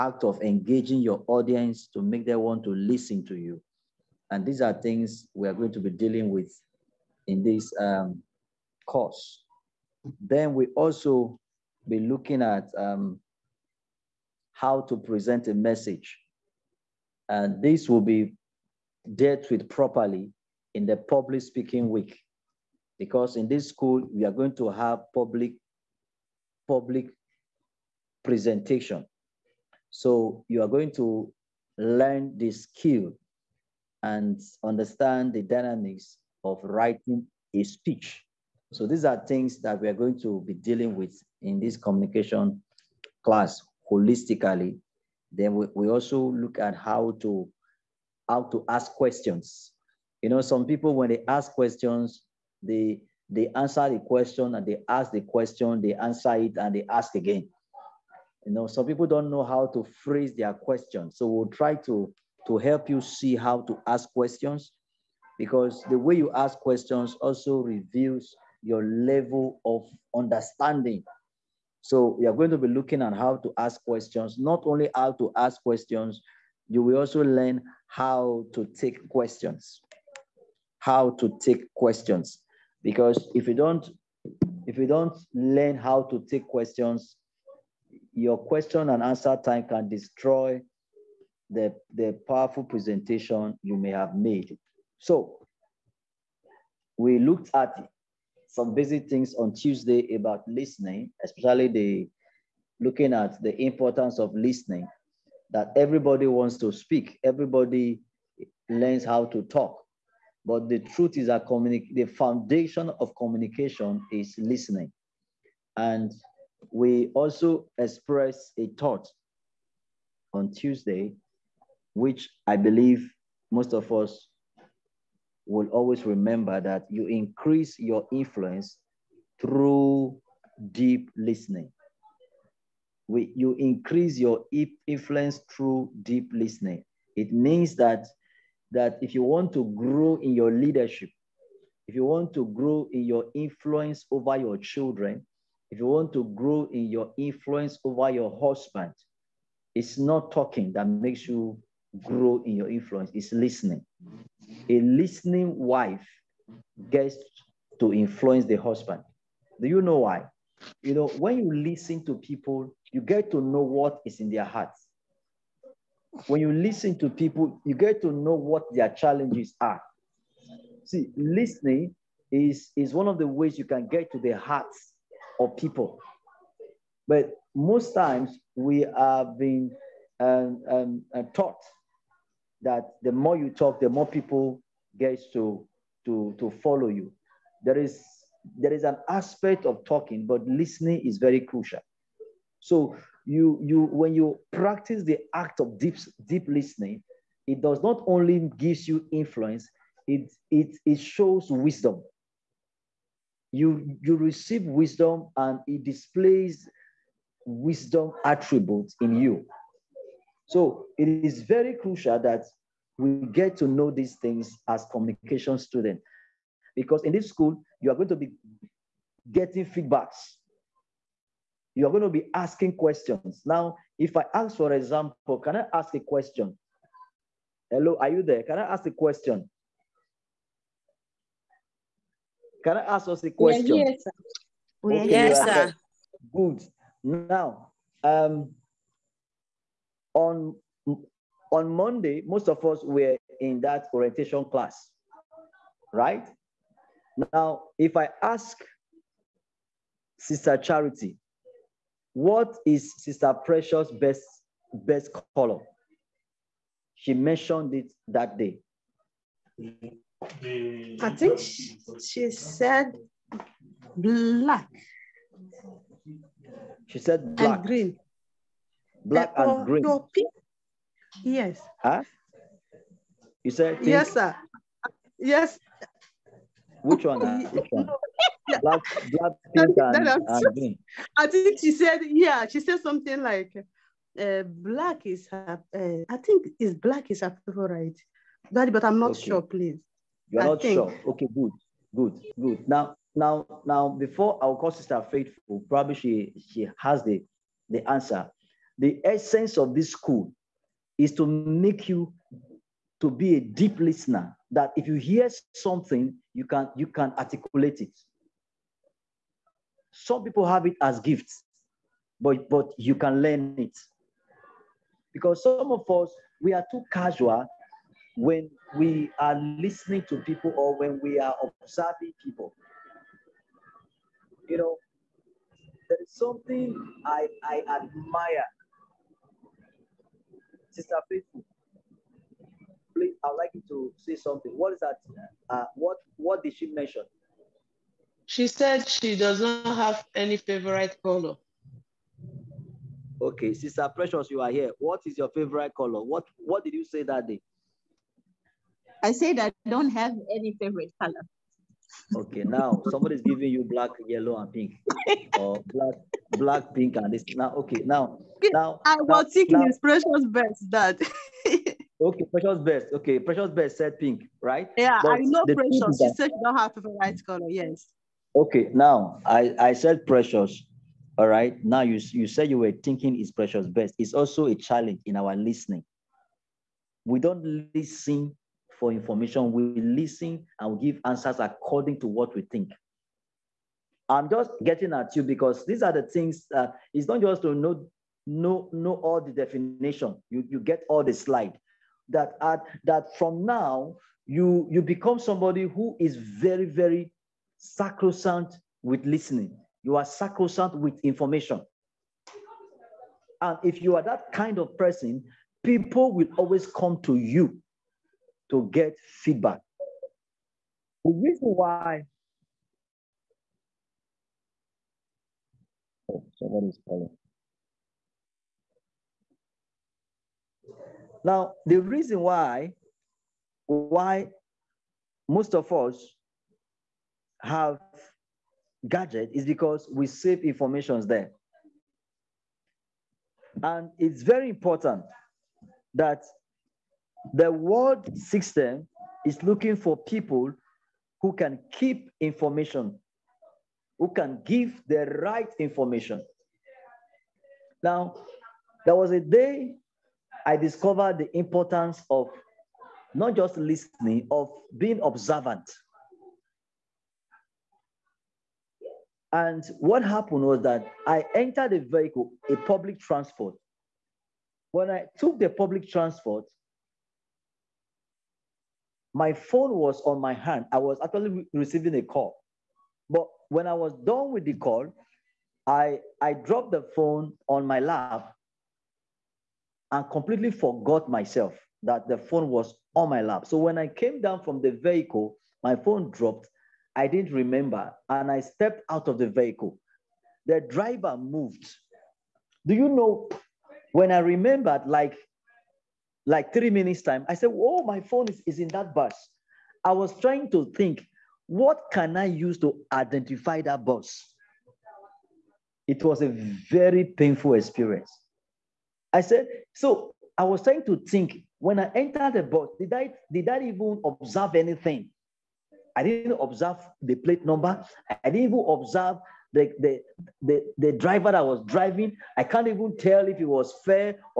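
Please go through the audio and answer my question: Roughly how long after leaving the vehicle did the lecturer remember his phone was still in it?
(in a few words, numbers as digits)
three minutes.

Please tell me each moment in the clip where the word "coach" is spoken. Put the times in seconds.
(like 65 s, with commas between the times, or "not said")
not said.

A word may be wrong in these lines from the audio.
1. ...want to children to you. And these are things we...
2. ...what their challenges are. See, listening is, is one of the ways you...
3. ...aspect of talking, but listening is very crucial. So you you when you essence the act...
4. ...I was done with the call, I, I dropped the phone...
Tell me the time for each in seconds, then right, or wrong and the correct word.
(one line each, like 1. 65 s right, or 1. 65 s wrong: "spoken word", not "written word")
1. 2 s wrong: "listen", not "children"
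2. 168 s right
3. 189 s wrong: "practice", not "essence"
4. 473 s right.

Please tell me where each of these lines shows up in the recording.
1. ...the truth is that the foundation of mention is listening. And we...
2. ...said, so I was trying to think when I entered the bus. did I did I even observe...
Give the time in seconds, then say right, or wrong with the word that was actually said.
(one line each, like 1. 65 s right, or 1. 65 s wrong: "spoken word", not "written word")
1. 110 s wrong: "communication", not "mention"
2. 509 s right.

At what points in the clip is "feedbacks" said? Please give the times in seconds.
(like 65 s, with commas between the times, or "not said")
219 s, 409 s.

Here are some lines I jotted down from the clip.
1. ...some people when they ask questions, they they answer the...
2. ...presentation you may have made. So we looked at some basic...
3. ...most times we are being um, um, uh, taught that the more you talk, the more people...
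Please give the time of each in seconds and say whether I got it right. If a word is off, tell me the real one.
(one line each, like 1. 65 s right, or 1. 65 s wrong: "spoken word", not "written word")
1. 50 s right
2. 92 s right
3. 177 s right.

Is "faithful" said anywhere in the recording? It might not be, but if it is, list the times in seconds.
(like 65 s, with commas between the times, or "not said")
295 s, 331 s.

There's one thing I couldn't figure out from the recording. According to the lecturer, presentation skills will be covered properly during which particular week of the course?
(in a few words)
public speaking week.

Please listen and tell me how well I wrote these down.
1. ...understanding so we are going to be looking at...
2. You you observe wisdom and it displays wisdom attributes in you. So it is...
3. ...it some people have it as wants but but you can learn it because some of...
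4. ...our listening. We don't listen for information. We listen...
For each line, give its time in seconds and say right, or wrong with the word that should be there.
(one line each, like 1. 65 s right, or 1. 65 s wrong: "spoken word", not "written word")
1. 70 s right
2. 203 s wrong: "receive", not "observe"
3. 307 s wrong: "gifts", not "wants"
4. 375 s right.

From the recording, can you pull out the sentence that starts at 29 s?
So you are going to learn the skill and understand the dynamics of writing a speech.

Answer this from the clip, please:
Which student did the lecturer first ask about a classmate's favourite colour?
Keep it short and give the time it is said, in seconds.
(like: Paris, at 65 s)
Sister Charity, at 250 s.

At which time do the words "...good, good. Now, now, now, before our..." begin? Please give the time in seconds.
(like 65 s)
291 s.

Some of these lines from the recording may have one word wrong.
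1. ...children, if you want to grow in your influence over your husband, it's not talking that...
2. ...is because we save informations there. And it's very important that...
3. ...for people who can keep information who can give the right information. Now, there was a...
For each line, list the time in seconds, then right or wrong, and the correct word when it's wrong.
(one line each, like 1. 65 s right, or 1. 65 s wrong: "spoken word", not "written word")
1. 144 s right
2. 429 s right
3. 439 s right.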